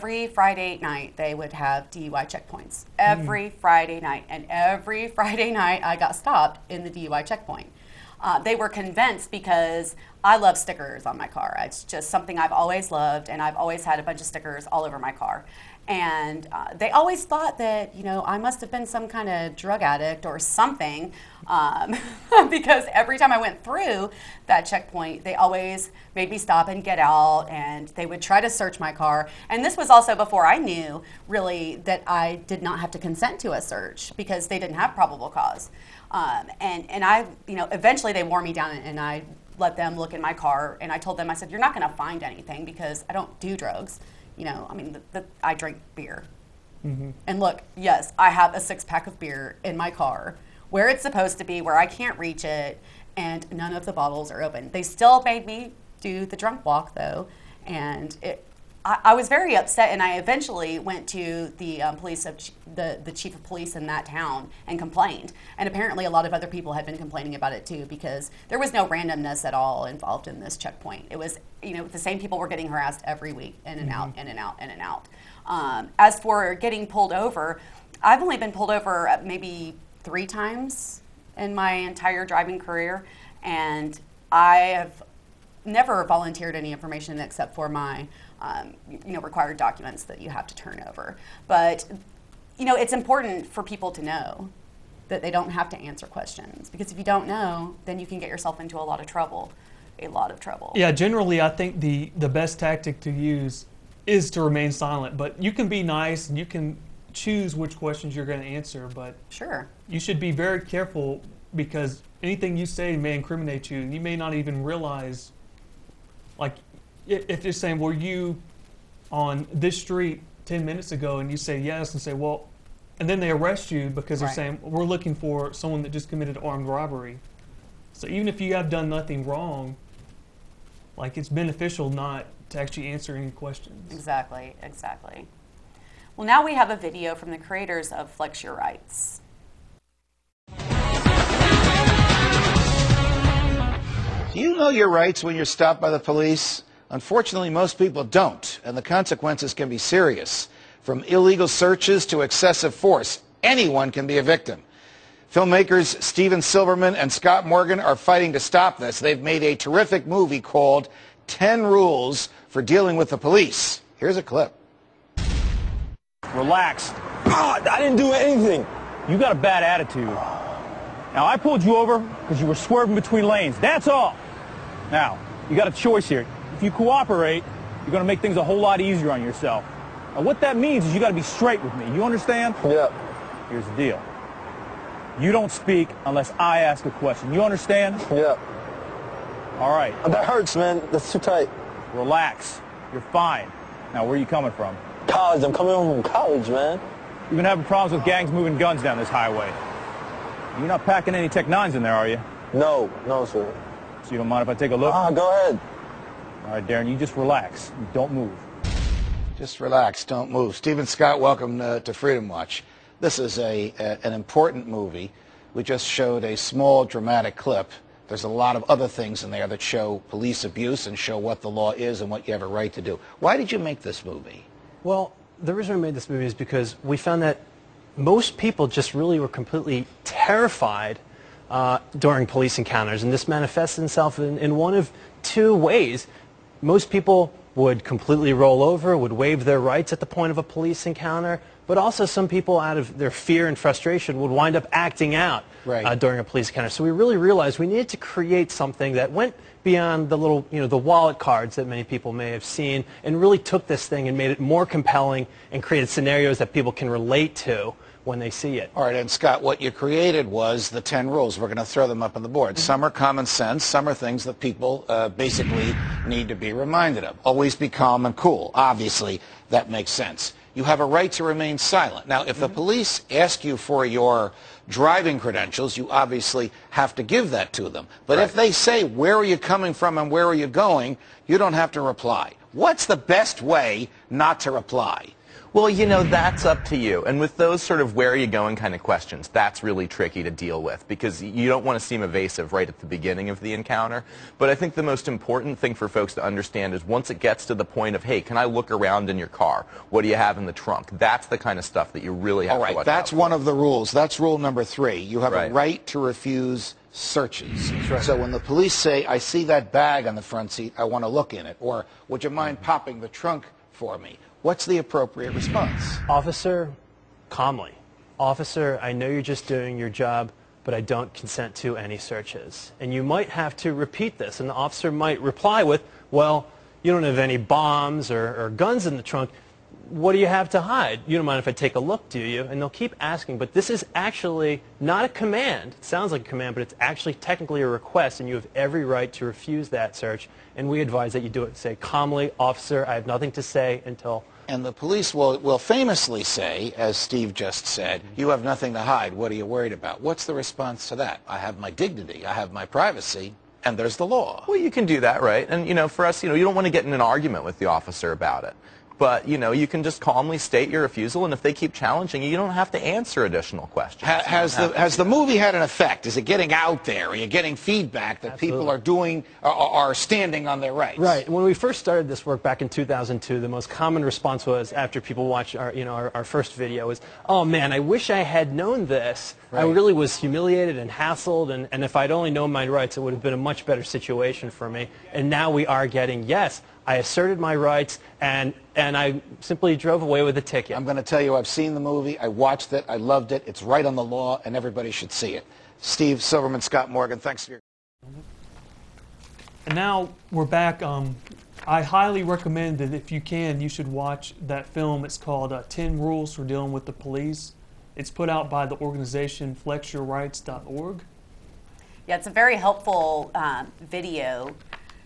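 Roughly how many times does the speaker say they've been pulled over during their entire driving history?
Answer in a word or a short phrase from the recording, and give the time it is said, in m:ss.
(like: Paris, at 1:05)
3, at 1:20.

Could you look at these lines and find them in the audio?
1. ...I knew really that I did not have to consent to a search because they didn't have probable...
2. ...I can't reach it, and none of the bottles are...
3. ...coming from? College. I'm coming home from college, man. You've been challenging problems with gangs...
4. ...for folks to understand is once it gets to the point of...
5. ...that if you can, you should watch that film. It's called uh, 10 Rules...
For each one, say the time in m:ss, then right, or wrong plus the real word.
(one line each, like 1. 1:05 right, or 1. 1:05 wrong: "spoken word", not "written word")
1. 0:30 right
2. 0:51 right
3. 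3:14 wrong: "having", not "challenging"
4. 4:55 right
5. 6:42 right.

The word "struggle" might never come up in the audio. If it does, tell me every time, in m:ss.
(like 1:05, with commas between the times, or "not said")
not said.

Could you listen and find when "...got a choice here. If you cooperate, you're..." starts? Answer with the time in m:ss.
2:55.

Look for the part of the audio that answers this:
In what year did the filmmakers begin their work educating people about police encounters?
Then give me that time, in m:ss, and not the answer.
6:12.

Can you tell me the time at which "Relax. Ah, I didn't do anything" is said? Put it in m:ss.
2:46.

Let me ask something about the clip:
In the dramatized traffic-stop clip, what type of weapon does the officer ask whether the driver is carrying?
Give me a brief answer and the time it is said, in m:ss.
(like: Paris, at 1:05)
TEC-9s, at 3:21.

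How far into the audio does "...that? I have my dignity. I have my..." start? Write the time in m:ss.
5:50.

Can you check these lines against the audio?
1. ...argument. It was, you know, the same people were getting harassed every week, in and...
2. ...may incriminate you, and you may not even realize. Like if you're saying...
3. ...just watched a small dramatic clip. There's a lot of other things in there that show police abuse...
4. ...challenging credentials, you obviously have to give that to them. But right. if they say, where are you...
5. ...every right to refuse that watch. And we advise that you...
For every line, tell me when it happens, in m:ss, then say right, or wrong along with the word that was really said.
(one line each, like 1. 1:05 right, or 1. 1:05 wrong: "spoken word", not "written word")
1. 1:10 wrong: "checkpoint", not "argument"
2. 1:52 right
3. 3:35 wrong: "showed", not "watched"
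4. 4:34 wrong: "driving", not "challenging"
5. 5:38 wrong: "search", not "watch".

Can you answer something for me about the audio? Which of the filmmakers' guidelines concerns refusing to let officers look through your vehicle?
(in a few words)
Rule number three.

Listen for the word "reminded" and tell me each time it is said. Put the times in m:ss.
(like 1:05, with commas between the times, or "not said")
4:26.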